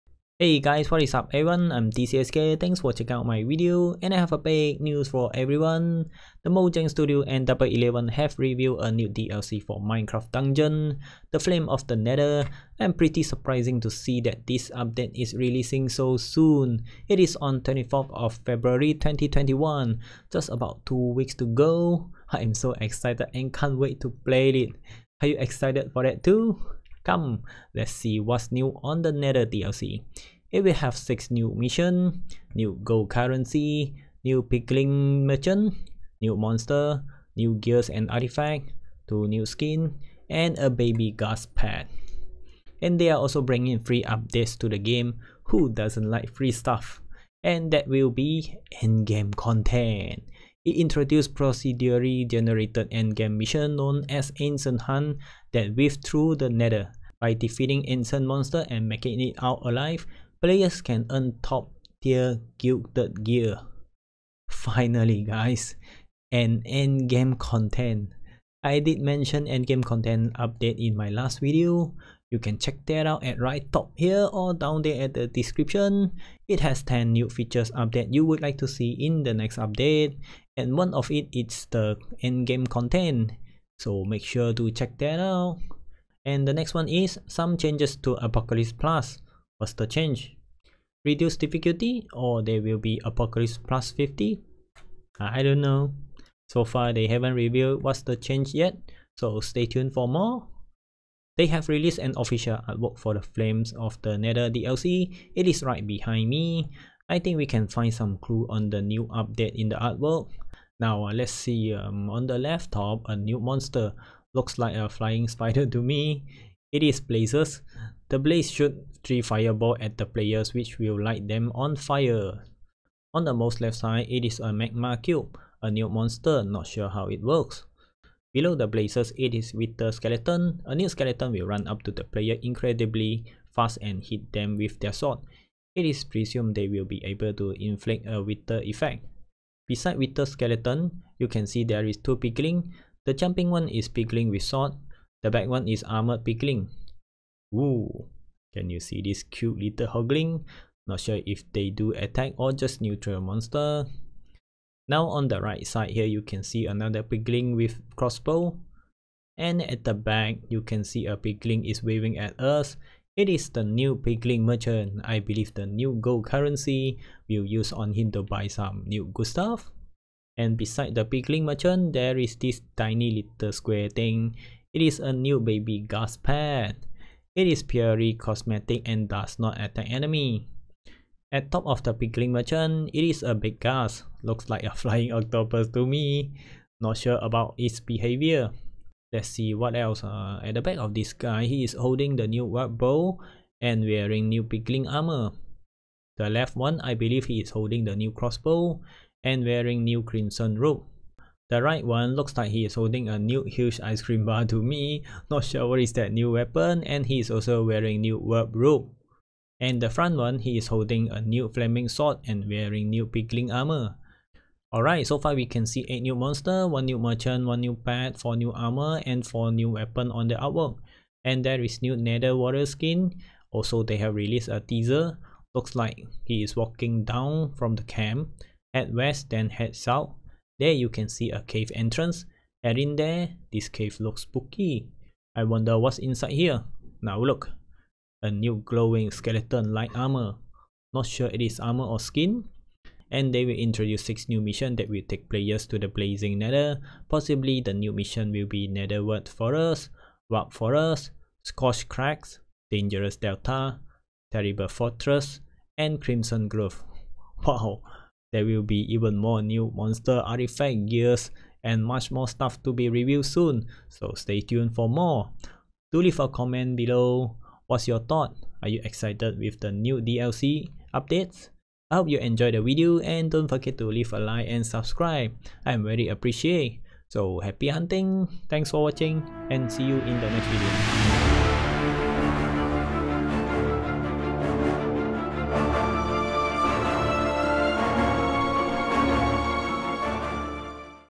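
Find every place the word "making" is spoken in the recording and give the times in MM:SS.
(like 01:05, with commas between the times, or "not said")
00:58.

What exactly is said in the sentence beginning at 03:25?
Not sure what is that new weapon and he is also wearing new warp robe.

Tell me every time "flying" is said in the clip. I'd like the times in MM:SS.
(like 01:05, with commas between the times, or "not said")
01:54, 03:04.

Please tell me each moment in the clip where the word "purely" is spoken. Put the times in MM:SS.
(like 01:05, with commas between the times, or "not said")
02:57.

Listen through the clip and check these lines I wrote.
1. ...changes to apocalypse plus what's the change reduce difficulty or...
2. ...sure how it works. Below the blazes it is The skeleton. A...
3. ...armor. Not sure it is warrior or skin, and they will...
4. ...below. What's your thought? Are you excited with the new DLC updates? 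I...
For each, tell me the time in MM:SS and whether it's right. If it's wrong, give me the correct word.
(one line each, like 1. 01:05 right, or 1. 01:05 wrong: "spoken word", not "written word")
1. 01:27 right
2. 02:06 wrong: "Wither", not "The"
3. 03:59 wrong: "armor", not "warrior"
4. 04:26 right.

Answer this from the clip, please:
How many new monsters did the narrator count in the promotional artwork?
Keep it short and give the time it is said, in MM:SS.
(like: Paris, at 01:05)
8, at 03:35.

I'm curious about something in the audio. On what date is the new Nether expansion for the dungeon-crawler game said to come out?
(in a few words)
24 February 2021.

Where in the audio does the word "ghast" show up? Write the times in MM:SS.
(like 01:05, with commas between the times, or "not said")
00:41, 02:55, 03:03.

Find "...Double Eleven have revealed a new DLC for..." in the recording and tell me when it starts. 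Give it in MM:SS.
00:07.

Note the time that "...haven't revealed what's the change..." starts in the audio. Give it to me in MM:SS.
01:37.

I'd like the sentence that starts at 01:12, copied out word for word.
You can check that out at right top here or down there at the description.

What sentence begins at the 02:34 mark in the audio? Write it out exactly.
Now on the right side here you can see another piglin with crossbow.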